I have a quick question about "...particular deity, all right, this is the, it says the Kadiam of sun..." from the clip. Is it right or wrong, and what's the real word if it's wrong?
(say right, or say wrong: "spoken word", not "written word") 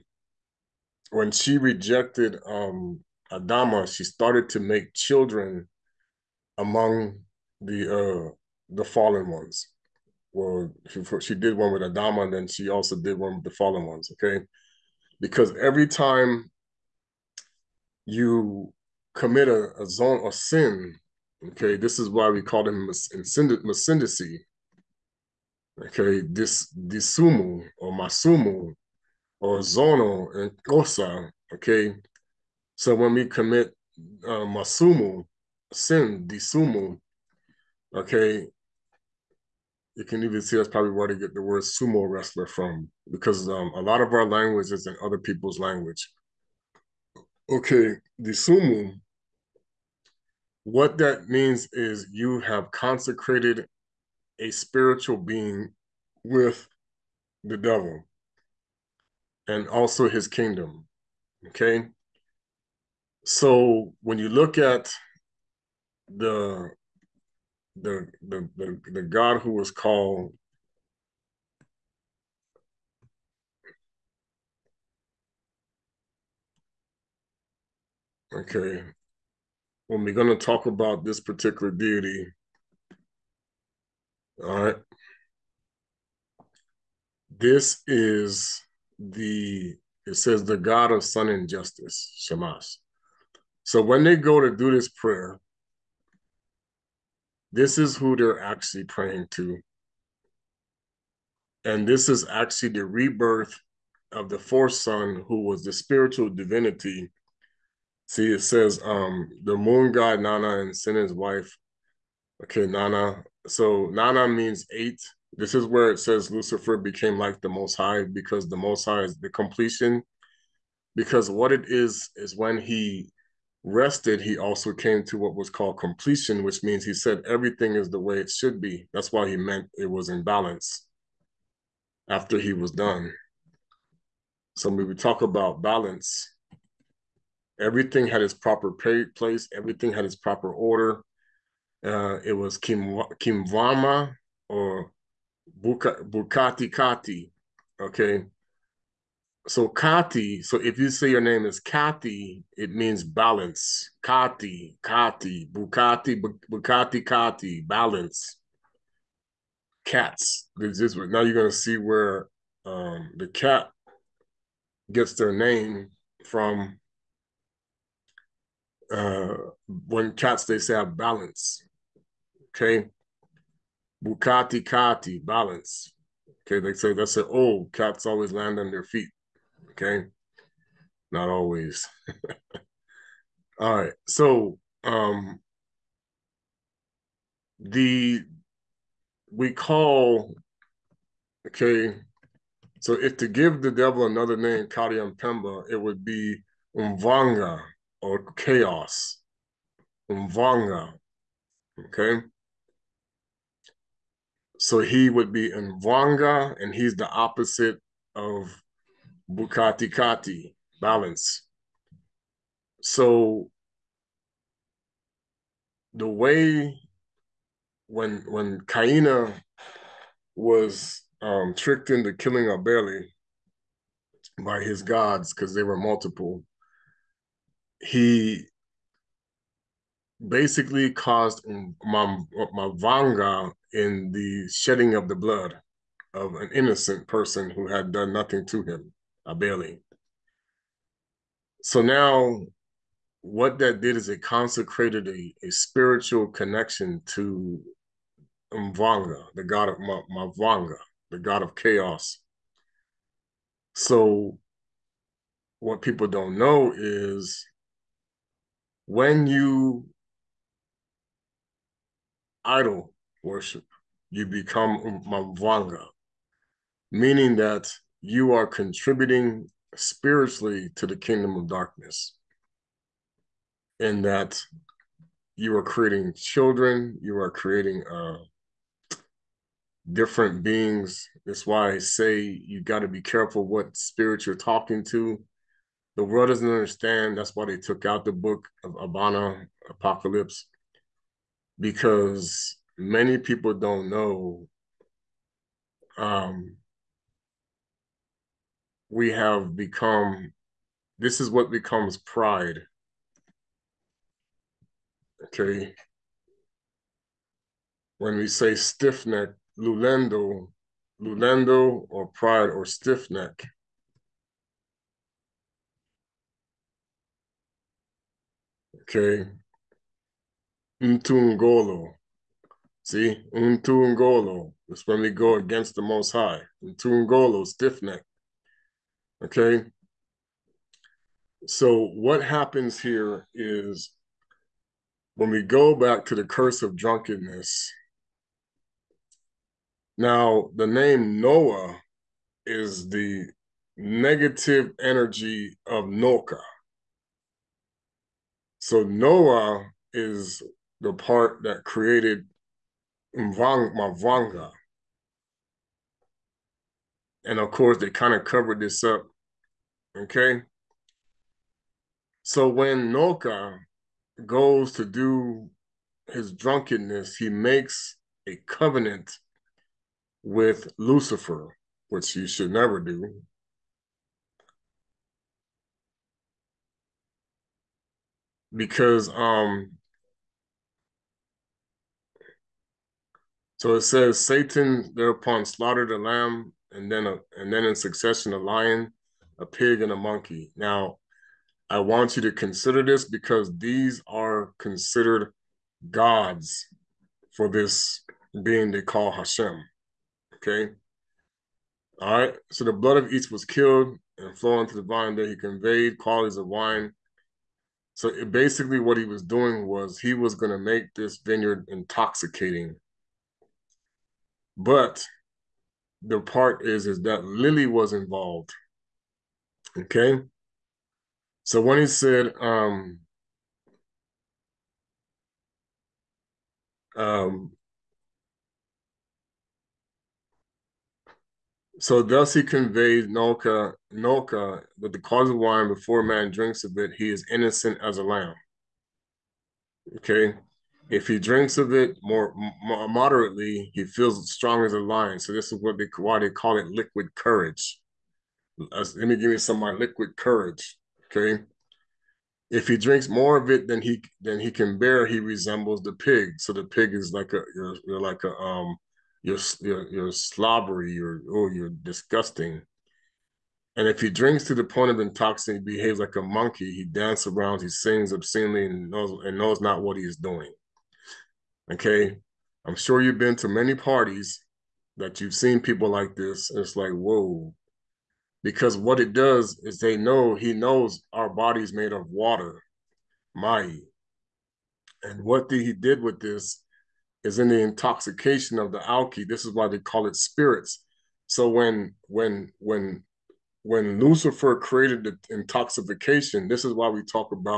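wrong: "God", not "Kadiam".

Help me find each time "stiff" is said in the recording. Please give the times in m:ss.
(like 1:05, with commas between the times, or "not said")
5:08, 5:12, 5:27.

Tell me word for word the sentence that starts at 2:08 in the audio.
That's why he meant it was in balance after he was done.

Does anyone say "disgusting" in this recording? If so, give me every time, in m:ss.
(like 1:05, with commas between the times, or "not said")
7:41.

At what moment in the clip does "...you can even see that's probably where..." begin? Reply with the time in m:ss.
0:39.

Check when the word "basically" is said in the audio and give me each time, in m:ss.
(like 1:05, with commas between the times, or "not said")
3:50, 6:48.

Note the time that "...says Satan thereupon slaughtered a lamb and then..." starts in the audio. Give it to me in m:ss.
6:23.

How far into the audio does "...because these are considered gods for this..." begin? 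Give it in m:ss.
6:33.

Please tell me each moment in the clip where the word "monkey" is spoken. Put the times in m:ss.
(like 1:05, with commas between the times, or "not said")
6:29, 7:46.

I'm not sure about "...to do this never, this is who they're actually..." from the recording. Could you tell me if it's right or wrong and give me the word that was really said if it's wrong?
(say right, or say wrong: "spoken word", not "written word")
wrong: "prayer", not "never".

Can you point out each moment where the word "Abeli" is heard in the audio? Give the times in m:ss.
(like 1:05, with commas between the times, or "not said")
3:42, 3:59.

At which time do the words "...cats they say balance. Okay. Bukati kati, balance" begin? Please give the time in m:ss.
2:50.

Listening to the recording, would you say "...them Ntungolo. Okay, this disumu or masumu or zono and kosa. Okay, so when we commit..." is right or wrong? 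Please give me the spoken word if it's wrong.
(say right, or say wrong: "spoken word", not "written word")
wrong: "Masindacy", not "Ntungolo".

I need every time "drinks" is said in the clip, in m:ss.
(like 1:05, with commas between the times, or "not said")
7:16, 7:21, 7:32, 7:44.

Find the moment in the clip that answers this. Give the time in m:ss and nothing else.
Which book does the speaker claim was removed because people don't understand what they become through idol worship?
4:48.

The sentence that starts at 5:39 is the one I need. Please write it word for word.
Now, the name Noah is the negative energy of Noah.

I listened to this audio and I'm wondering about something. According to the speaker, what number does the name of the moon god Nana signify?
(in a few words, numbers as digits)
8.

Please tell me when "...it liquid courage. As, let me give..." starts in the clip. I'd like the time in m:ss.
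7:26.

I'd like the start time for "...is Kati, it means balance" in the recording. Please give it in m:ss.
2:31.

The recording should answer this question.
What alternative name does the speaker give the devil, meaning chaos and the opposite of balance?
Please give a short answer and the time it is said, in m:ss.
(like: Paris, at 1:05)
Umvanga, at 3:16.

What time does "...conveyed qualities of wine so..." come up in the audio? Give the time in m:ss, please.
6:45.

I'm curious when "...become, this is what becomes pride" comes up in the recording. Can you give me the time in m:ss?
4:59.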